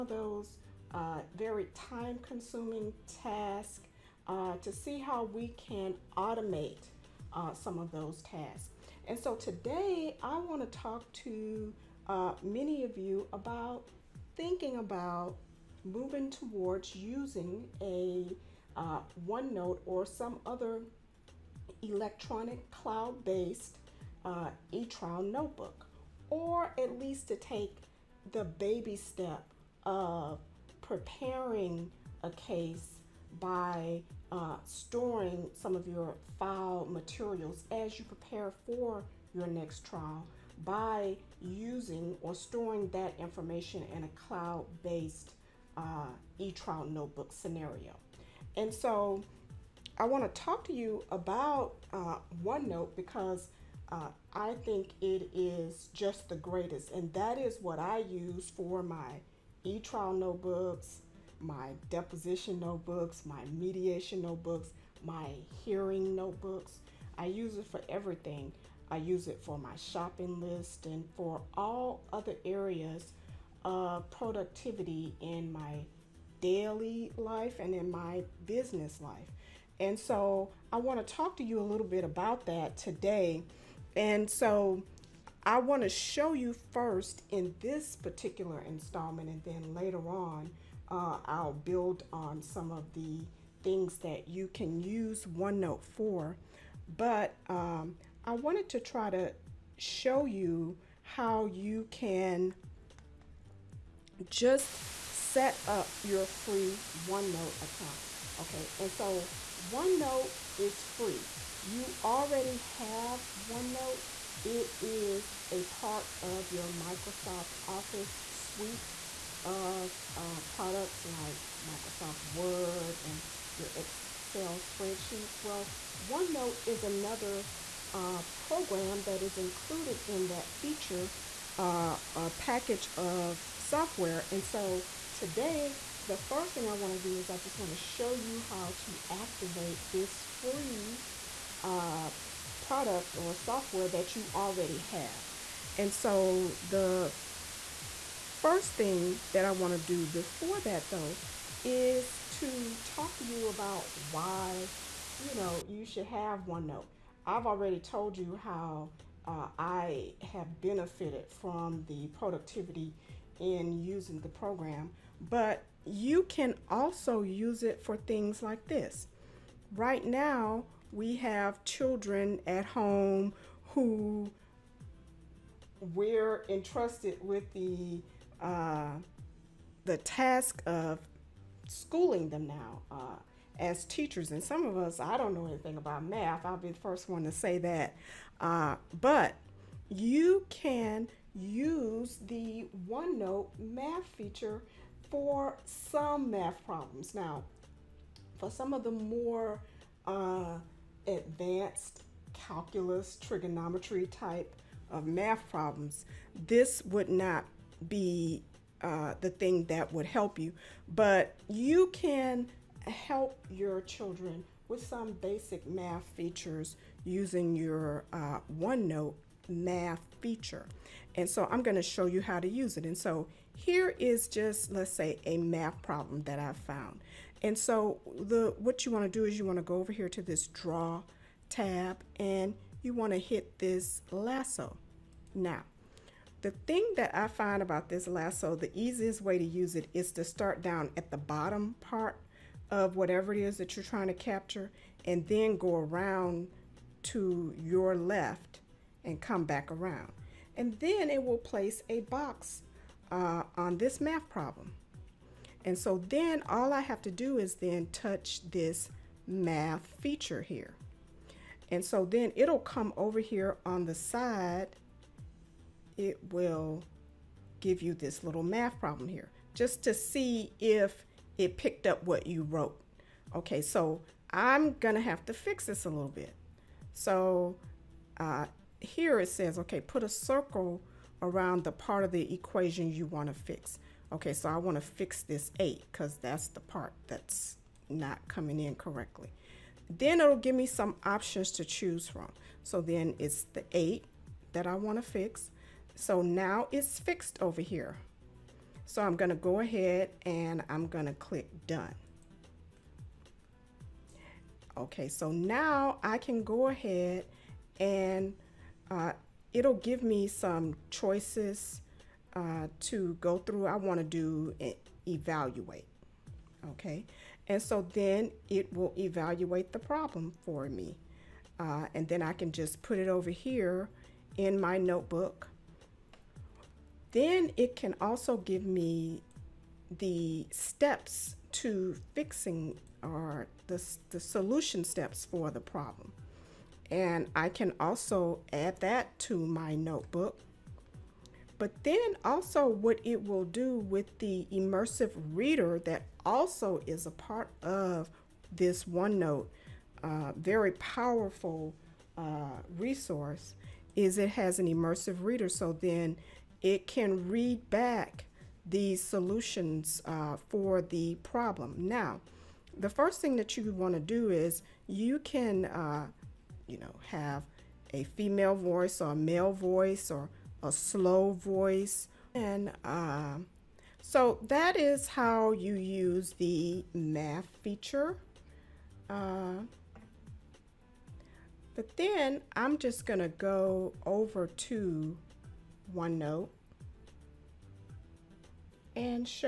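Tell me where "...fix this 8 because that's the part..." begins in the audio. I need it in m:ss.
4:44.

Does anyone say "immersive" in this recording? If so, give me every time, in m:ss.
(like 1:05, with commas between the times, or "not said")
5:44, 5:54.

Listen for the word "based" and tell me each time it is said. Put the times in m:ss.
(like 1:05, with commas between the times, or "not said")
0:23, 0:44.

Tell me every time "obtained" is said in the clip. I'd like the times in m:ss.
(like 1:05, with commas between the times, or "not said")
not said.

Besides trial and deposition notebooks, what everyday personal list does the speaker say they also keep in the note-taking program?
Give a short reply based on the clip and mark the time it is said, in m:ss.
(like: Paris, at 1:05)
Shopping list, at 1:09.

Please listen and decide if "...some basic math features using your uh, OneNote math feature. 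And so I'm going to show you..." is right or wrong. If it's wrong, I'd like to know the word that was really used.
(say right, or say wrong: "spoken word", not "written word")
right.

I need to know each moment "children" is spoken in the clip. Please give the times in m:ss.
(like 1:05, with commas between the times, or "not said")
2:51, 3:33.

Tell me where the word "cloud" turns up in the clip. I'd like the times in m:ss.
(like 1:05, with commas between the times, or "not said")
0:22, 0:44.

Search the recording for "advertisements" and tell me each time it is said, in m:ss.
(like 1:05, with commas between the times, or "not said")
not said.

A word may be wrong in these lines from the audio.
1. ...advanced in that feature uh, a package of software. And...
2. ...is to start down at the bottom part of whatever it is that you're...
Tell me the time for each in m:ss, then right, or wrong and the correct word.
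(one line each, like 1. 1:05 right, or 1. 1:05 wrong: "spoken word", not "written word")
1. 2:09 wrong: "included", not "advanced"
2. 3:59 right.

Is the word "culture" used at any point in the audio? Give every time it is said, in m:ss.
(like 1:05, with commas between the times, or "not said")
not said.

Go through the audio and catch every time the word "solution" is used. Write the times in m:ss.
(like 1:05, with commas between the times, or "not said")
5:34, 5:58.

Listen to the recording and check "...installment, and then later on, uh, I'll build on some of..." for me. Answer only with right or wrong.
right.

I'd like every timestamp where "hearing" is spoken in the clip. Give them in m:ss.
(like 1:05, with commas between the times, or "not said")
1:05.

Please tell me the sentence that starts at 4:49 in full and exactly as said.
Then it'll give me some options to choose from.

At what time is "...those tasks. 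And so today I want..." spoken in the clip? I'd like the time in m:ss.
0:07.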